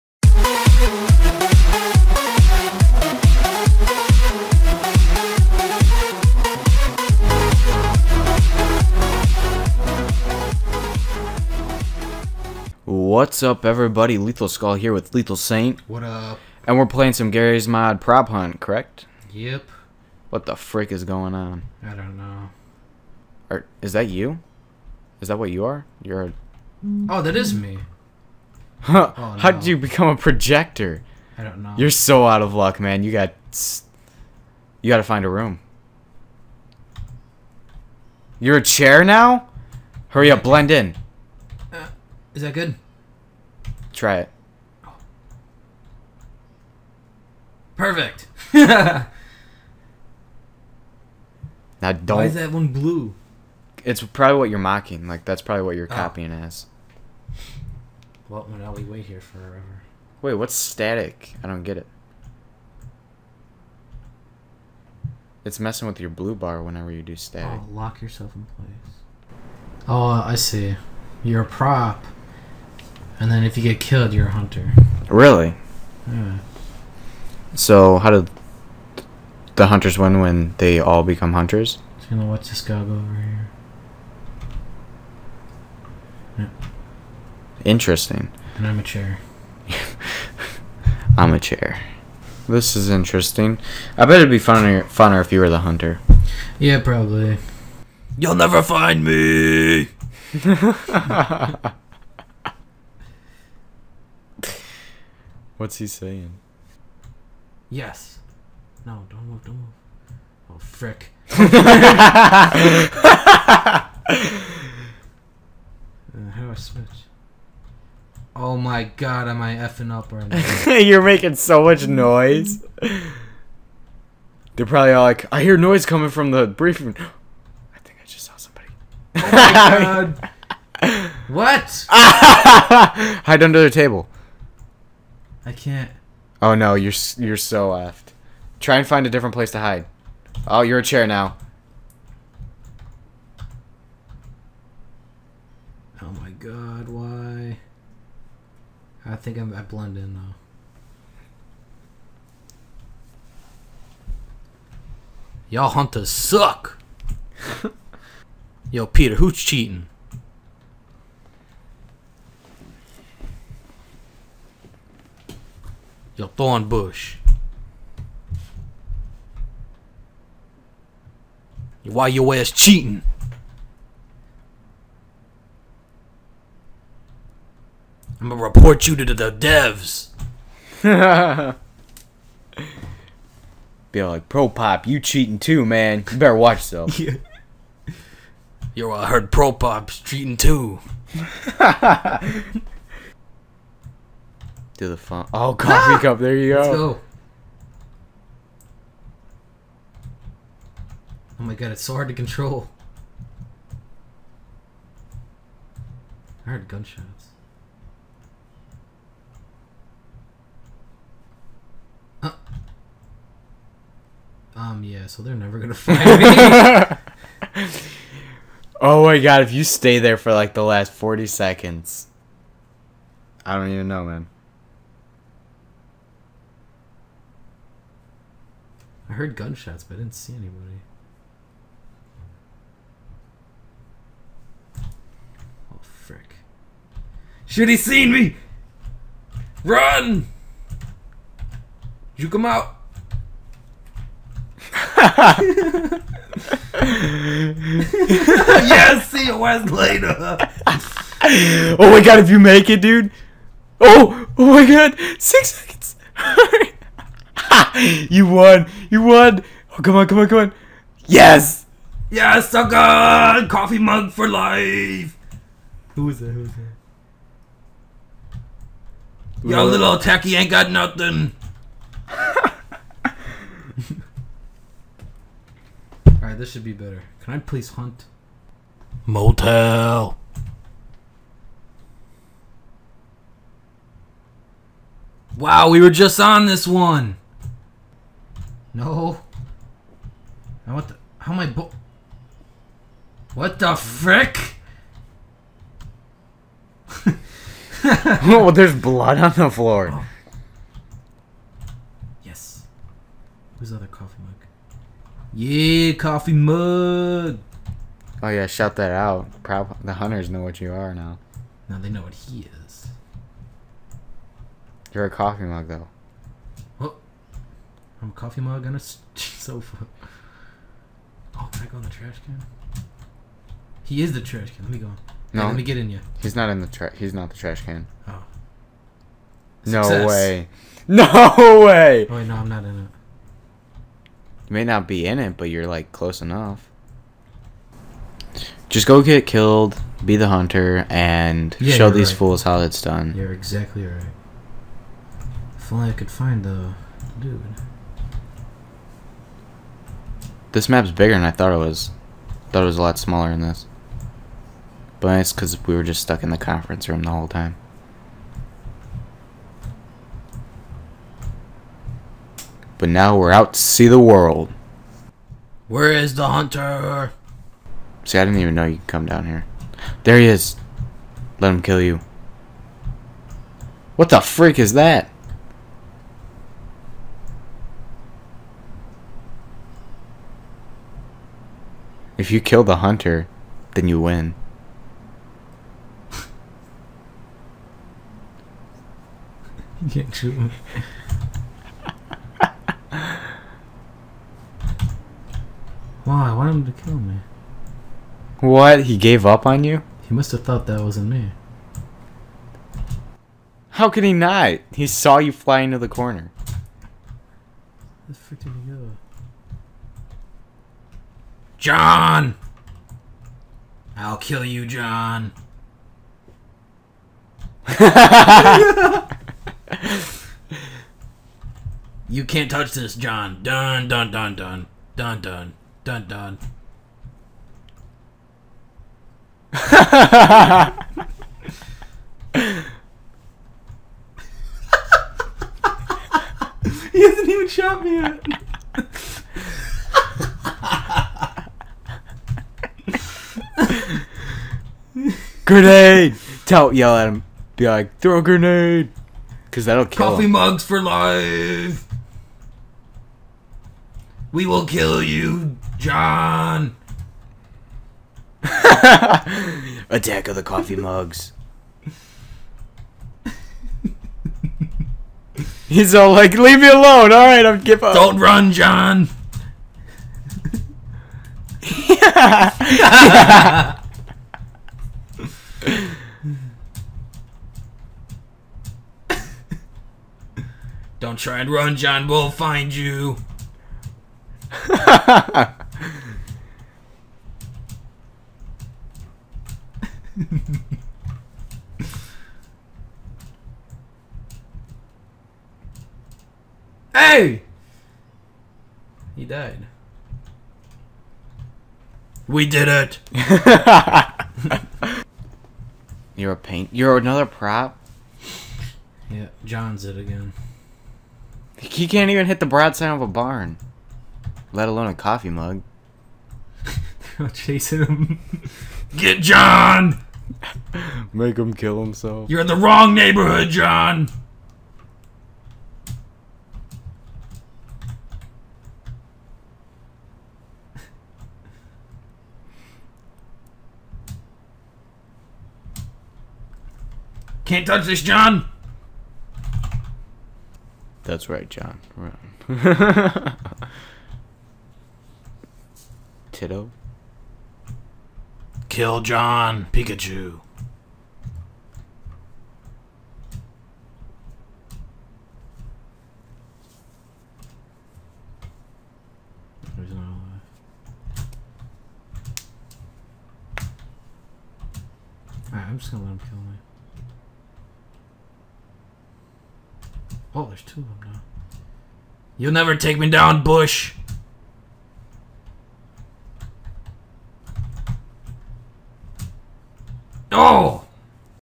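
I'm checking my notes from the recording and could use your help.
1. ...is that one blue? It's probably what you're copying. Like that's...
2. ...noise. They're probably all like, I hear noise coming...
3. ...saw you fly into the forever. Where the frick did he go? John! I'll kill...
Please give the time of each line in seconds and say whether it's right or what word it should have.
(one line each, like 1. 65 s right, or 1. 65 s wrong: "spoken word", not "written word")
1. 52 s wrong: "mocking", not "copying"
2. 121 s right
3. 404 s wrong: "corner", not "forever".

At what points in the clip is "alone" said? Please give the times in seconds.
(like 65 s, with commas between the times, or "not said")
466 s, 514 s.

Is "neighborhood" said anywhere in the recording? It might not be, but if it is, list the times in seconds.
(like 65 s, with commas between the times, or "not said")
522 s.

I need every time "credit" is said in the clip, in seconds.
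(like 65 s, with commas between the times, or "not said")
not said.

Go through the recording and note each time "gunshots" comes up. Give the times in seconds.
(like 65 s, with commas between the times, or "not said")
206 s, 229 s.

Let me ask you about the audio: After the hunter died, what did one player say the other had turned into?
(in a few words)
A paint.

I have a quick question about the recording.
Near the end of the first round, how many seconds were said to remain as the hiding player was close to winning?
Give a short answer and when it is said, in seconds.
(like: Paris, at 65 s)
6, at 255 s.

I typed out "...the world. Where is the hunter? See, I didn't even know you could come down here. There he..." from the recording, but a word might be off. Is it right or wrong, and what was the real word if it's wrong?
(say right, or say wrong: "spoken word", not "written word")
right.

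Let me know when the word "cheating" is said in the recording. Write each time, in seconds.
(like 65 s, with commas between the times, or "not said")
159 s, 172 s, 185 s, 189 s.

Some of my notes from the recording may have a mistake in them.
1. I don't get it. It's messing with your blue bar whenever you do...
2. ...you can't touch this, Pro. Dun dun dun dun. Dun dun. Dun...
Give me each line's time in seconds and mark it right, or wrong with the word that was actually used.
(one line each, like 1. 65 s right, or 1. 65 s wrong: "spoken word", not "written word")
1. 61 s right
2. 422 s wrong: "John", not "Pro".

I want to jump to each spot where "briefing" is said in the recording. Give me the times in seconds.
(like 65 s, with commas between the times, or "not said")
126 s.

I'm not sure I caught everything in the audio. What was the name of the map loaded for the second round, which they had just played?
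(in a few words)
Motel.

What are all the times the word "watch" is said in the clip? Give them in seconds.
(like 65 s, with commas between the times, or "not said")
82 s, 186 s.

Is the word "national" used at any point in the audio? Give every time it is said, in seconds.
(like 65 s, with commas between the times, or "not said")
not said.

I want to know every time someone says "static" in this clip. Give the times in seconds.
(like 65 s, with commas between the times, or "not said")
60 s, 67 s.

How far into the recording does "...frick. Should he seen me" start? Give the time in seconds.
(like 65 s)
235 s.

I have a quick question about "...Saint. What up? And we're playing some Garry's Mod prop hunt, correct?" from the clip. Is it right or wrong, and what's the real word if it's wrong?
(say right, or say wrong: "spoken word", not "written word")
right.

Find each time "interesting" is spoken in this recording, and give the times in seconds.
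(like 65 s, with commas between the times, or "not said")
87 s, 92 s.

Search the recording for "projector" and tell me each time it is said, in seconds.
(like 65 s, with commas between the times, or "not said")
30 s.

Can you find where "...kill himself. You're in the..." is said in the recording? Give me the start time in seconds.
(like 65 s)
521 s.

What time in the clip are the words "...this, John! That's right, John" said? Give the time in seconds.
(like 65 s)
537 s.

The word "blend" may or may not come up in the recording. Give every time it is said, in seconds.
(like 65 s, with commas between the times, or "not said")
40 s, 149 s.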